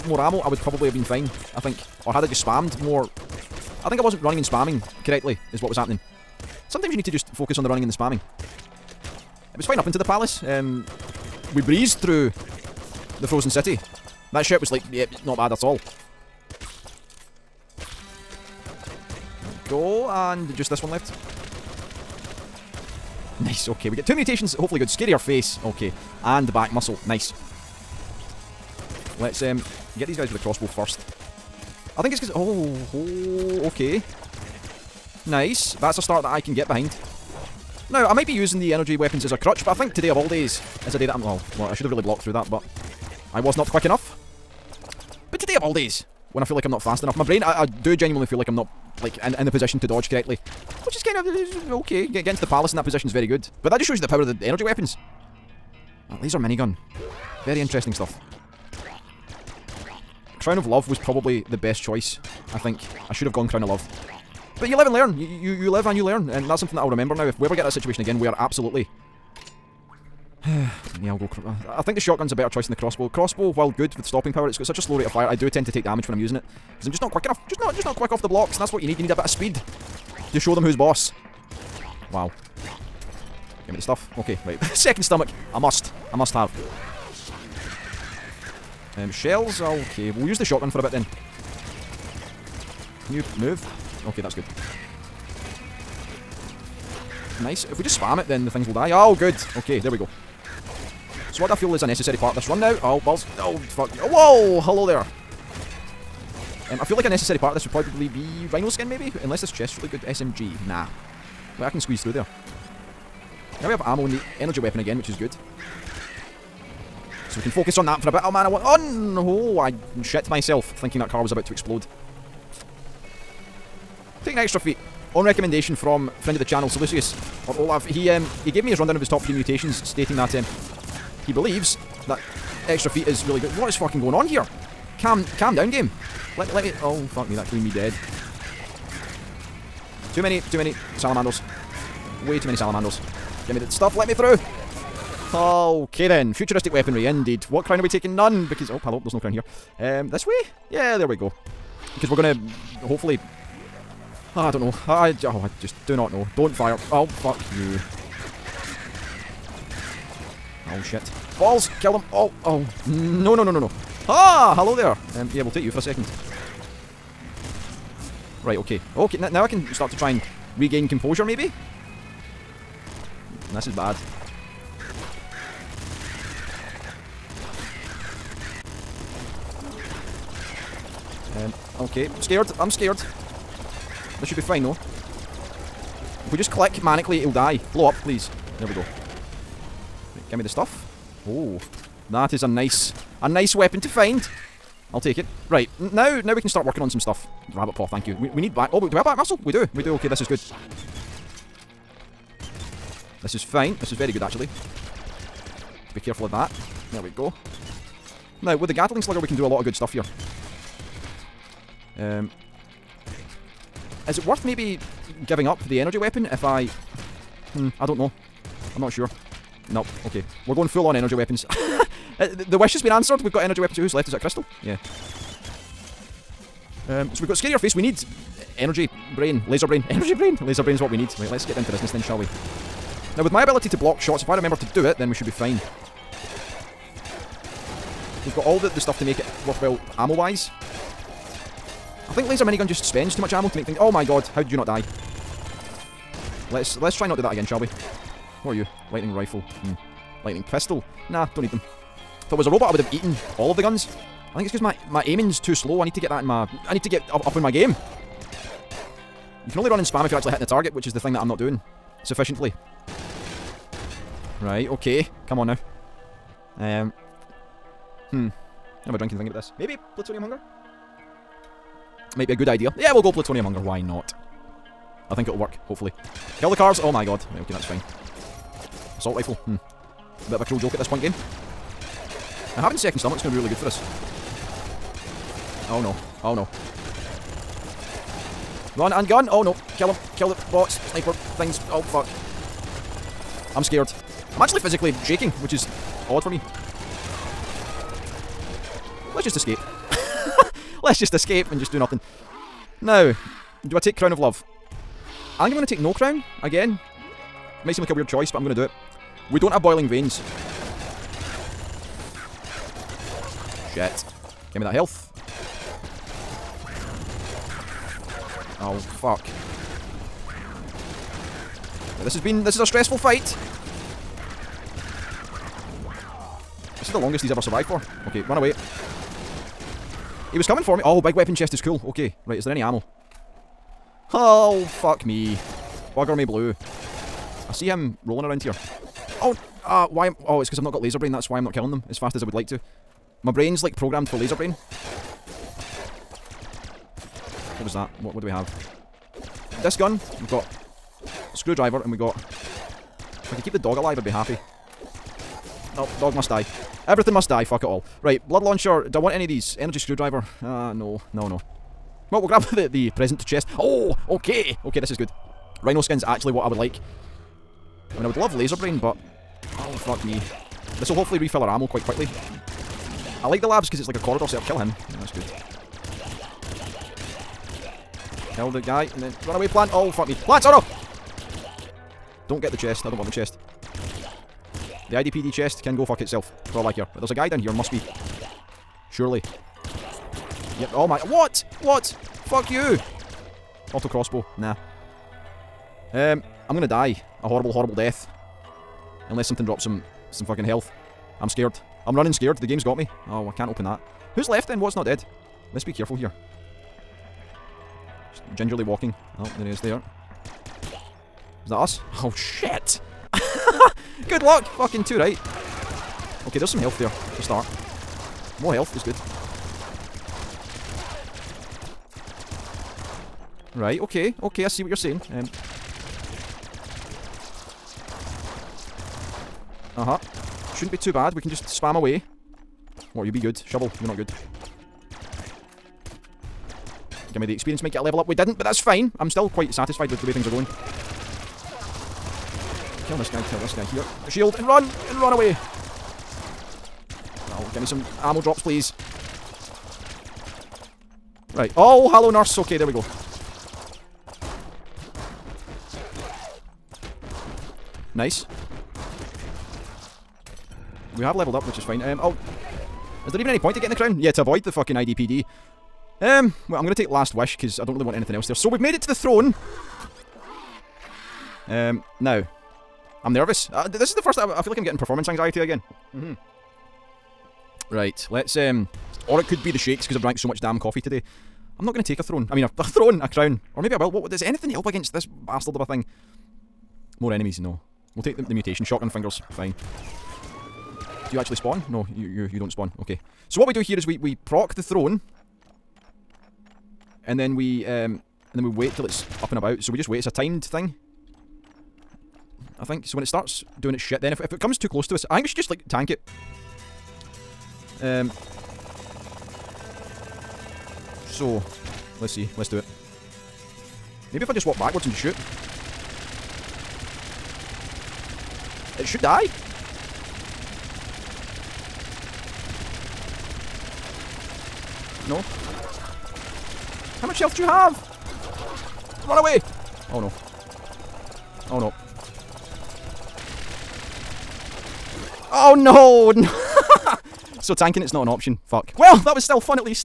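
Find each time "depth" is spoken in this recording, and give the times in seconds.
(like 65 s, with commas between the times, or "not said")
not said.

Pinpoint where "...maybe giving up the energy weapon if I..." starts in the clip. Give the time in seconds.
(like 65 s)
214 s.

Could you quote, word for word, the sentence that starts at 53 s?
But that just shows you the power of the energy weapons.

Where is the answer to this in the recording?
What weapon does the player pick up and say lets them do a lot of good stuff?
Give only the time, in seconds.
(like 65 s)
208 s.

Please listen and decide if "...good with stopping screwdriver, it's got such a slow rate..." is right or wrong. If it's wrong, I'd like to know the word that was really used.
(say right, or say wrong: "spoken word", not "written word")
wrong: "power", not "screwdriver".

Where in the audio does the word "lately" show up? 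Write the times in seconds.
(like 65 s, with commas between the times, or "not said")
not said.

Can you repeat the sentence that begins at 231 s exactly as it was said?
Right, let's get down to business then, shall we?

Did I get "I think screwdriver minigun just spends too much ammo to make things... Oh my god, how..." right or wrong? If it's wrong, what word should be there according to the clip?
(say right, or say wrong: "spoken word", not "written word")
wrong: "laser", not "screwdriver".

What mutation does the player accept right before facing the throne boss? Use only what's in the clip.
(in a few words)
Shotgun fingers.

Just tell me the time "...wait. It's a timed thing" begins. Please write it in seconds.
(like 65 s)
499 s.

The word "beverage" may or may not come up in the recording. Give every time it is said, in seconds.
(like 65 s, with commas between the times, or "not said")
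not said.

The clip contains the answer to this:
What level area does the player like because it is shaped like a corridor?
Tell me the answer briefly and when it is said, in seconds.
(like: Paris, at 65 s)
The labs, at 373 s.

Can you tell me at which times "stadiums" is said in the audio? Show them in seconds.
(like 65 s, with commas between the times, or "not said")
not said.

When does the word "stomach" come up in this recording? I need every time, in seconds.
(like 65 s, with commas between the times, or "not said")
85 s, 282 s.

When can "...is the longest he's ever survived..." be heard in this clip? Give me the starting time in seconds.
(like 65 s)
326 s.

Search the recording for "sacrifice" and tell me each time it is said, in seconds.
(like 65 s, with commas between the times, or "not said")
not said.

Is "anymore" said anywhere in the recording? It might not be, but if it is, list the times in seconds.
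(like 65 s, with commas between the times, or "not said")
not said.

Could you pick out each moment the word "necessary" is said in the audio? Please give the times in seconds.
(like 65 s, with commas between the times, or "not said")
101 s, 107 s.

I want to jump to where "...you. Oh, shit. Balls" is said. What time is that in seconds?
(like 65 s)
157 s.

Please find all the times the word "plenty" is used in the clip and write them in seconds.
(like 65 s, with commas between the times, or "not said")
not said.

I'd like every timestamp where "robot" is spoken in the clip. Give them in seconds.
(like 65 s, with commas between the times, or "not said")
252 s.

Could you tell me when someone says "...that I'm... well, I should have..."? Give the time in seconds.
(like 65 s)
41 s.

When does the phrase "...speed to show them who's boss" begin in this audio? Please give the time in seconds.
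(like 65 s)
79 s.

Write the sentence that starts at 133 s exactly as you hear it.
What is fucking going on here?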